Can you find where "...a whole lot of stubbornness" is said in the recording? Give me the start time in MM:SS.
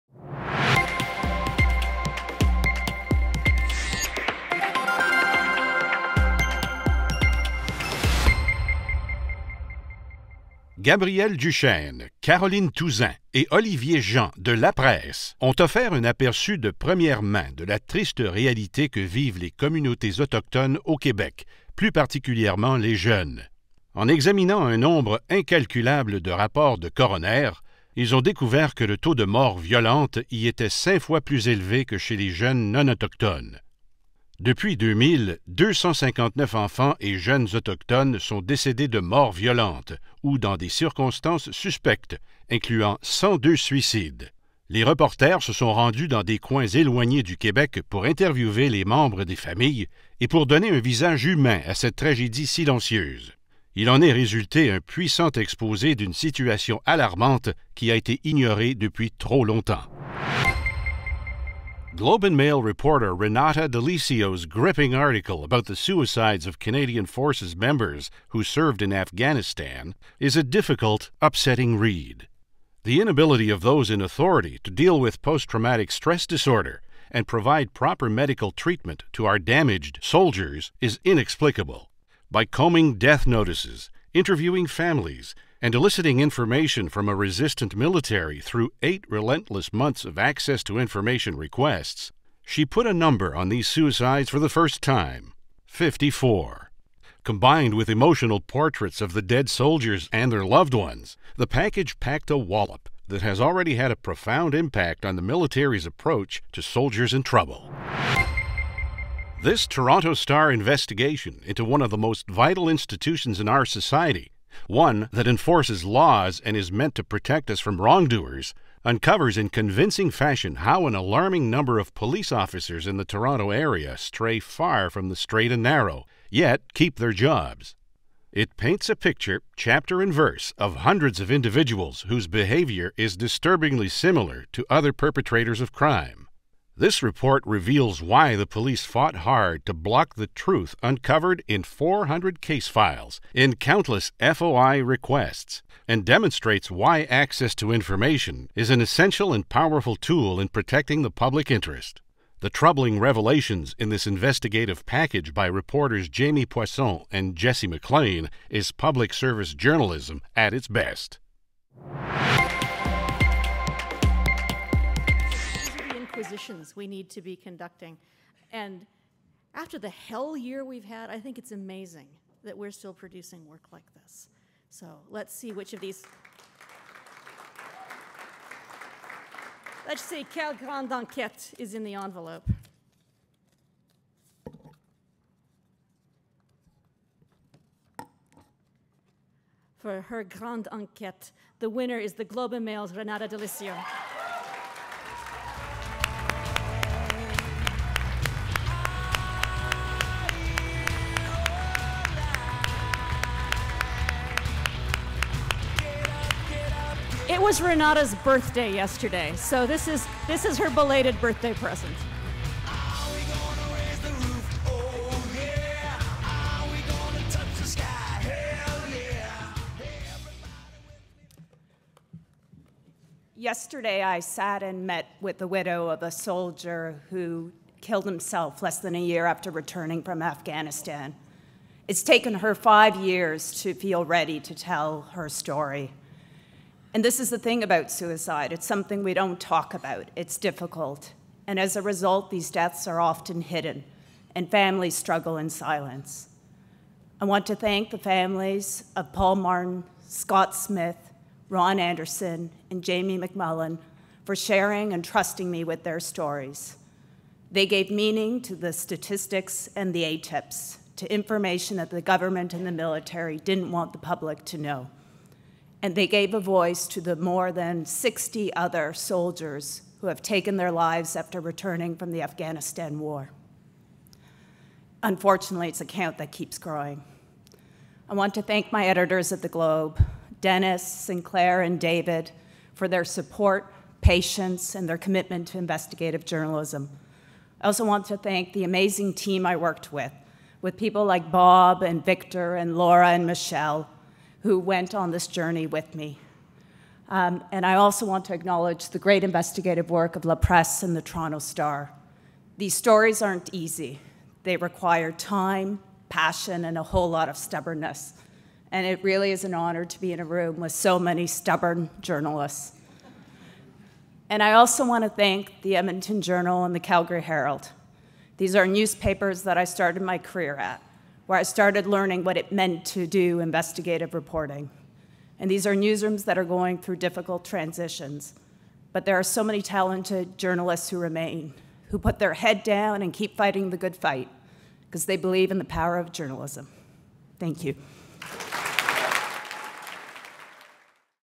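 05:06.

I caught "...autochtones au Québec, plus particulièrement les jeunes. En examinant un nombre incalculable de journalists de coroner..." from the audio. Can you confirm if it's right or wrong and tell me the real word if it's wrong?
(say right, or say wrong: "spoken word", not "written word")
wrong: "rapports", not "journalists".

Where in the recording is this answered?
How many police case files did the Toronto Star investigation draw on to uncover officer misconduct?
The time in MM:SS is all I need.
02:21.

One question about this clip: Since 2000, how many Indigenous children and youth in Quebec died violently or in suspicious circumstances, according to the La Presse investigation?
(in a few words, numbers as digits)
259.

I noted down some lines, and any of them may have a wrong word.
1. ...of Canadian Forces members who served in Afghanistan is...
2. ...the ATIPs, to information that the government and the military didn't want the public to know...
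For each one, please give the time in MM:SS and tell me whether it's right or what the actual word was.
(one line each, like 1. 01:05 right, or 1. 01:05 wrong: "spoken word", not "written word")
1. 01:06 right
2. 04:19 right.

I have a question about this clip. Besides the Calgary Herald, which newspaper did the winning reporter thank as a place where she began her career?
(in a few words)
Edmonton Journal.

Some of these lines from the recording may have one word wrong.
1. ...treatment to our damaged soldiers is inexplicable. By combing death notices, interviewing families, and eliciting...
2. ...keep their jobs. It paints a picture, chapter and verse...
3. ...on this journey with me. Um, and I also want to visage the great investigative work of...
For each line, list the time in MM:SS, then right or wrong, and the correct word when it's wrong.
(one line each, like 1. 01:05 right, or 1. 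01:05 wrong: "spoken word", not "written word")
1. 01:18 right
2. 02:06 right
3. 04:54 wrong: "acknowledge", not "visage".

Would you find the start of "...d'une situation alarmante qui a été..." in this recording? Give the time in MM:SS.
00:55.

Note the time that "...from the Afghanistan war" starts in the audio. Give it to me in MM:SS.
04:31.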